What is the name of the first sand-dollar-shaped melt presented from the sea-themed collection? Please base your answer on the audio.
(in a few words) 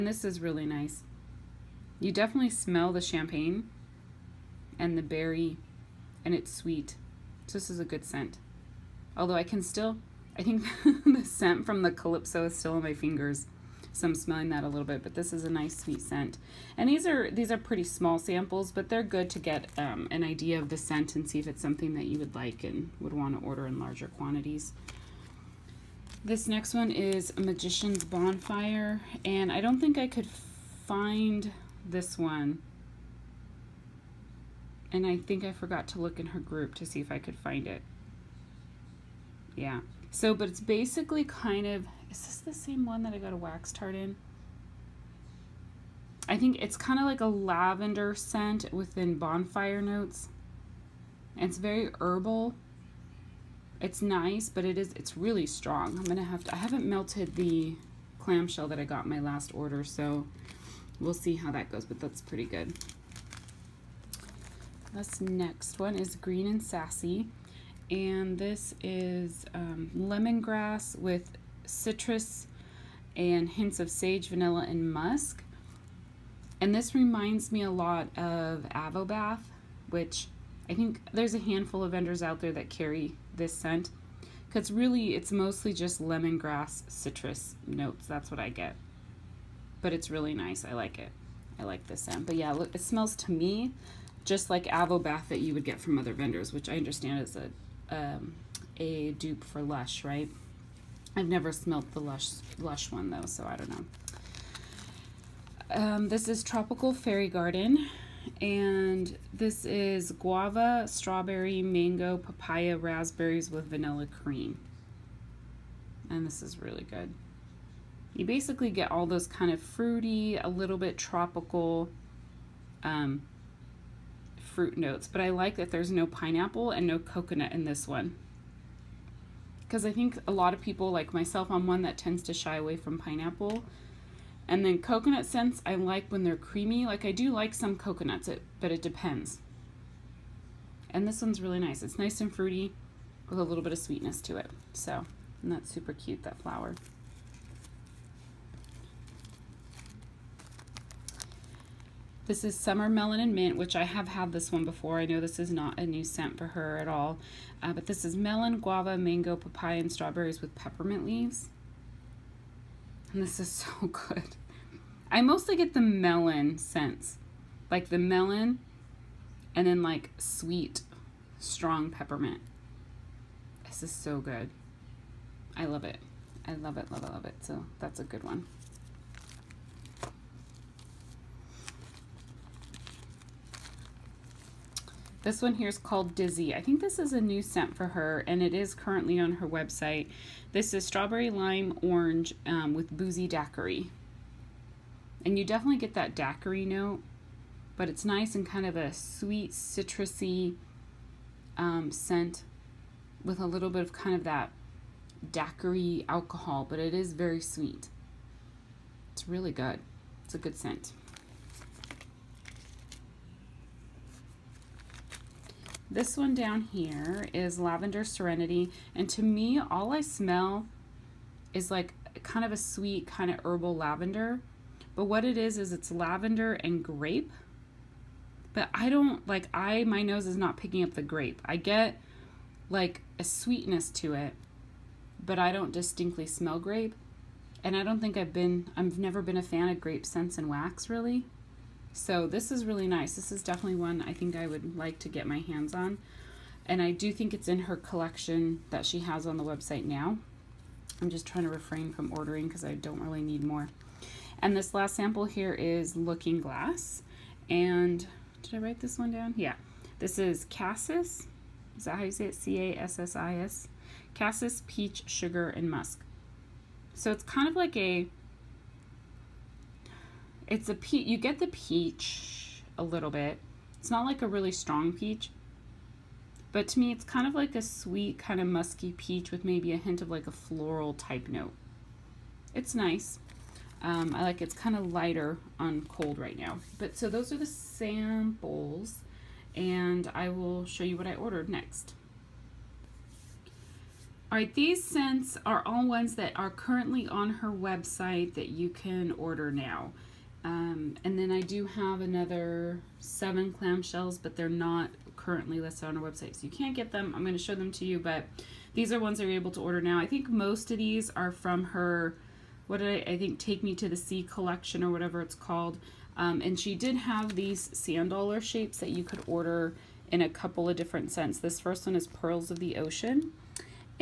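Pearls of the Ocean.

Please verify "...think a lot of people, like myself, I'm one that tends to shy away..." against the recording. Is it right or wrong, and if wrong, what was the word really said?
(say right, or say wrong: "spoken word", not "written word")
right.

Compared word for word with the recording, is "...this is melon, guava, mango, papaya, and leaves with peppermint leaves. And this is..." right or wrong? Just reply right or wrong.
wrong.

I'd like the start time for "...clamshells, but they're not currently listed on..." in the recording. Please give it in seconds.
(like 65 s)
303 s.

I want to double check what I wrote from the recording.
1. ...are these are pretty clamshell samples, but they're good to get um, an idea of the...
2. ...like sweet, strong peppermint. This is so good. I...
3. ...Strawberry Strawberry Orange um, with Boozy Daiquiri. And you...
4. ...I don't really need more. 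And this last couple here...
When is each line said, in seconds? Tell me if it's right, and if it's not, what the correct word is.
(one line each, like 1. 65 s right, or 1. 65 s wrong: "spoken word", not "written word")
1. 17 s wrong: "small", not "clamshell"
2. 169 s right
3. 190 s wrong: "Lime", not "Strawberry"
4. 252 s wrong: "sample", not "couple".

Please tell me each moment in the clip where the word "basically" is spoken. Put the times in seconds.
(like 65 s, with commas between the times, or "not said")
40 s, 118 s.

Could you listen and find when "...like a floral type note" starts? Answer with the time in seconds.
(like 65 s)
280 s.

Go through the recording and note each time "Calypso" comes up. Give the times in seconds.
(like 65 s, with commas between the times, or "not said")
11 s.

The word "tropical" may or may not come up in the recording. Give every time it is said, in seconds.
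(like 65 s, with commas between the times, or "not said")
106 s, 120 s.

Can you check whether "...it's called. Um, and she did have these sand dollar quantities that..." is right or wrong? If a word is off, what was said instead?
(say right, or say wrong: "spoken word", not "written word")
wrong: "shapes", not "quantities".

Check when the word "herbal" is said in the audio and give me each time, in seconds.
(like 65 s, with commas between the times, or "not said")
51 s, 223 s.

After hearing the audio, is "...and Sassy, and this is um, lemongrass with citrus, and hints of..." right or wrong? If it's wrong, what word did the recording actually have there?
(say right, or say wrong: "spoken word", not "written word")
right.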